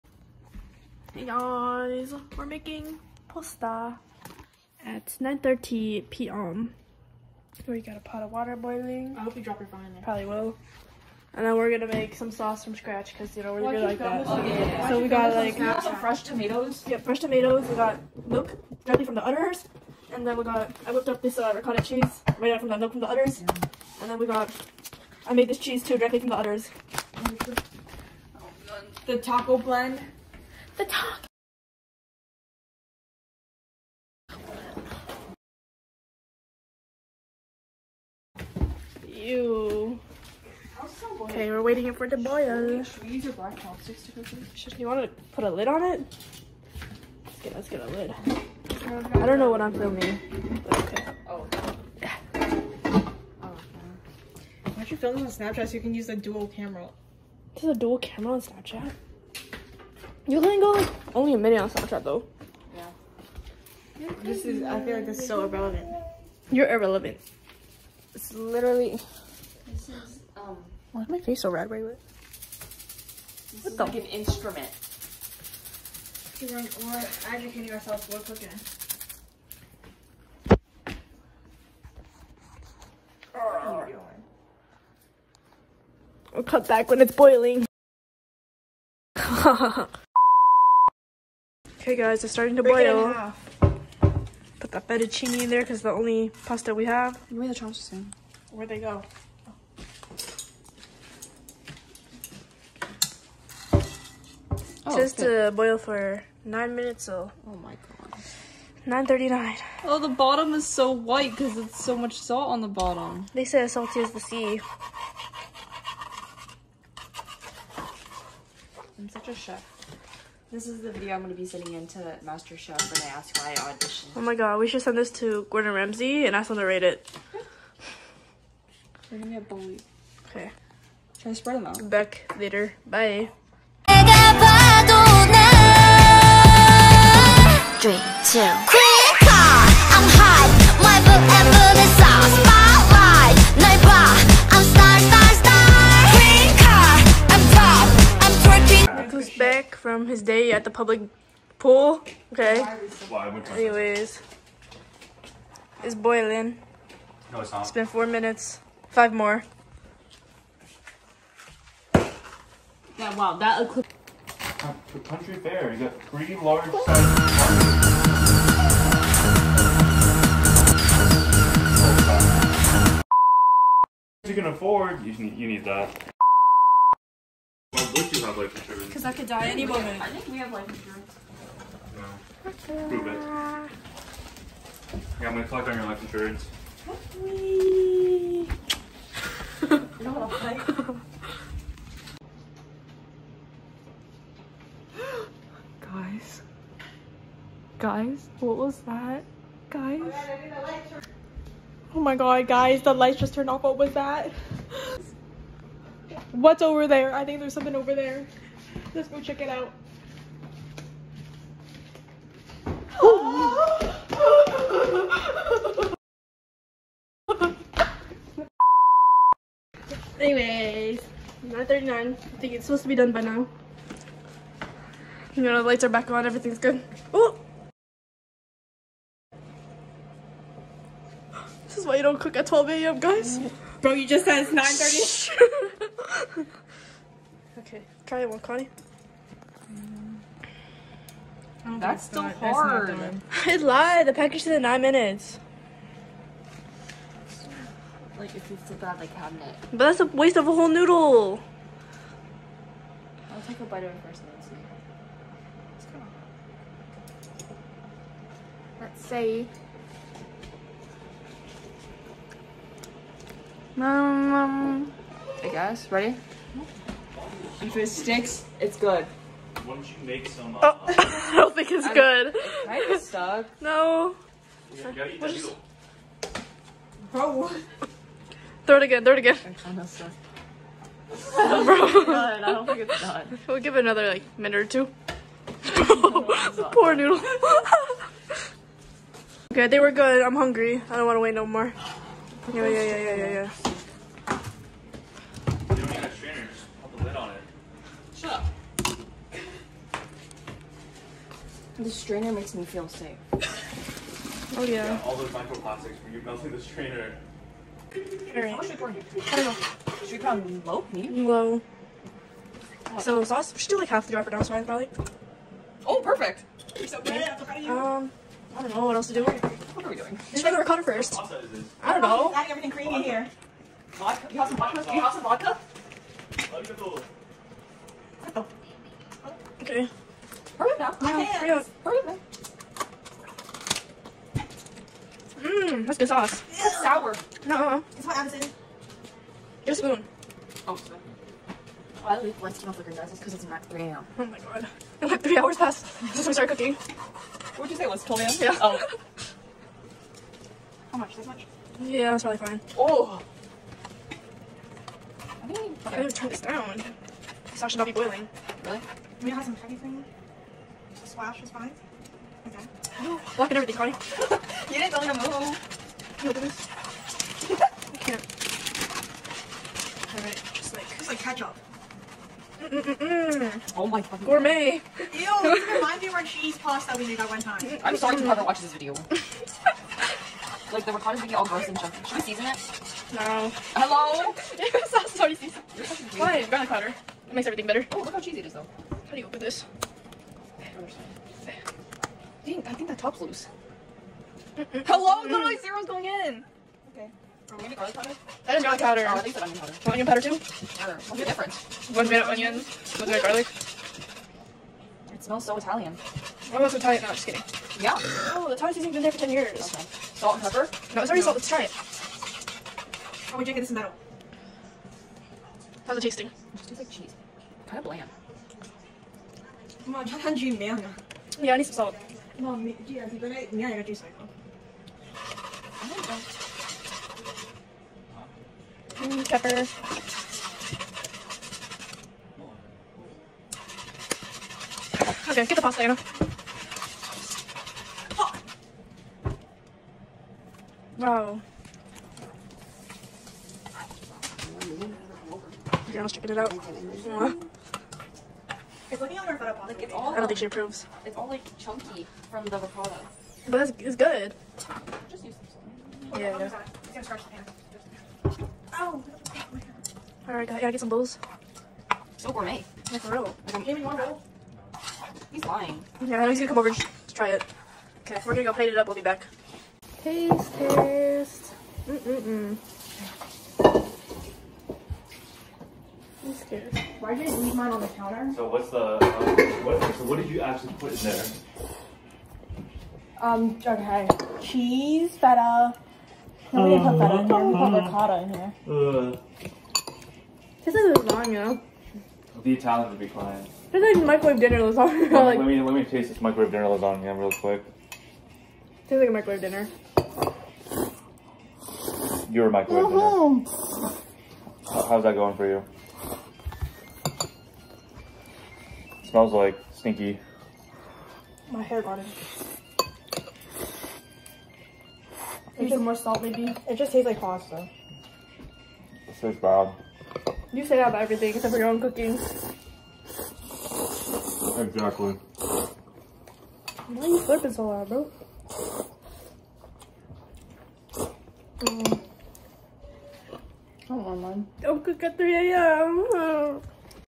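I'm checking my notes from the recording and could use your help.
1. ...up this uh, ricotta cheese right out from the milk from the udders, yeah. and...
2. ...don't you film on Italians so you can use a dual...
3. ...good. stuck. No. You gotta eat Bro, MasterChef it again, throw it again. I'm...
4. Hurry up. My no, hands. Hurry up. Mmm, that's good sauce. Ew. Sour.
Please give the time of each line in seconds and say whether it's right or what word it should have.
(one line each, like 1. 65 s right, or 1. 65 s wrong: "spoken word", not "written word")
1. 21 s right
2. 54 s wrong: "Snapchat", not "Italians"
3. 271 s wrong: "Throw", not "MasterChef"
4. 330 s right.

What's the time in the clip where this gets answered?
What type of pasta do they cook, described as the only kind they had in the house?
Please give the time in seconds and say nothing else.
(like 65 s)
94 s.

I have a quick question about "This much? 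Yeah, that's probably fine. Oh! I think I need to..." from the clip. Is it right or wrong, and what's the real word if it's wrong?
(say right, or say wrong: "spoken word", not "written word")
right.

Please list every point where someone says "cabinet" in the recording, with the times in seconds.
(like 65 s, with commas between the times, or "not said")
249 s.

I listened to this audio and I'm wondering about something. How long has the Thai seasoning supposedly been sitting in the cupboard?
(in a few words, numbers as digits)
10 years.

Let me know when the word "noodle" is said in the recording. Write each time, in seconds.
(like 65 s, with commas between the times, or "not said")
250 s, 286 s.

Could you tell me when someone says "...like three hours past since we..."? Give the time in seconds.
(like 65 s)
345 s.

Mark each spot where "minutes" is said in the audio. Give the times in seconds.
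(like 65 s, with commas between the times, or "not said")
61 s, 106 s, 158 s, 244 s, 284 s.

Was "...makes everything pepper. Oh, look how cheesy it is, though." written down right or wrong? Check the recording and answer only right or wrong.
wrong.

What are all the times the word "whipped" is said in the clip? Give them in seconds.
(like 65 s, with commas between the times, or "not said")
20 s.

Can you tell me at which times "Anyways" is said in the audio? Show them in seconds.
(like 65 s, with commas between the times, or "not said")
153 s, 220 s.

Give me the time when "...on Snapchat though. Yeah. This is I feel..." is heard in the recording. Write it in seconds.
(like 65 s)
61 s.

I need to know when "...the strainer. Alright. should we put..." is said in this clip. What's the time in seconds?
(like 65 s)
306 s.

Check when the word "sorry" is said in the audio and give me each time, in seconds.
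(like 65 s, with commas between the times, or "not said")
340 s, 378 s, 385 s.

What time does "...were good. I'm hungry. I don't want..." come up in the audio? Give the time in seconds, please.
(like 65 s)
289 s.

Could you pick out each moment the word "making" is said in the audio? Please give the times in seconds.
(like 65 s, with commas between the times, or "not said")
2 s.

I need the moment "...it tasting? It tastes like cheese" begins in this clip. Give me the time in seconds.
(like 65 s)
415 s.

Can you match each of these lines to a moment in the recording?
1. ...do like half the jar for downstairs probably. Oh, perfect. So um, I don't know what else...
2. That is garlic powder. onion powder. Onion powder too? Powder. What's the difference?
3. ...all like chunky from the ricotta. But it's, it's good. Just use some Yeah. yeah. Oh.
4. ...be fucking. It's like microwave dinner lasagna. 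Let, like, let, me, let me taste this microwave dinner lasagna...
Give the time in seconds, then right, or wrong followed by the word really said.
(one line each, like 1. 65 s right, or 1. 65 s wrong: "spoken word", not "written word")
1. 313 s right
2. 398 s right
3. 451 s right
4. 492 s wrong: "crying", not "fucking".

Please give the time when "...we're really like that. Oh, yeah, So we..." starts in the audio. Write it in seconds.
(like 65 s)
13 s.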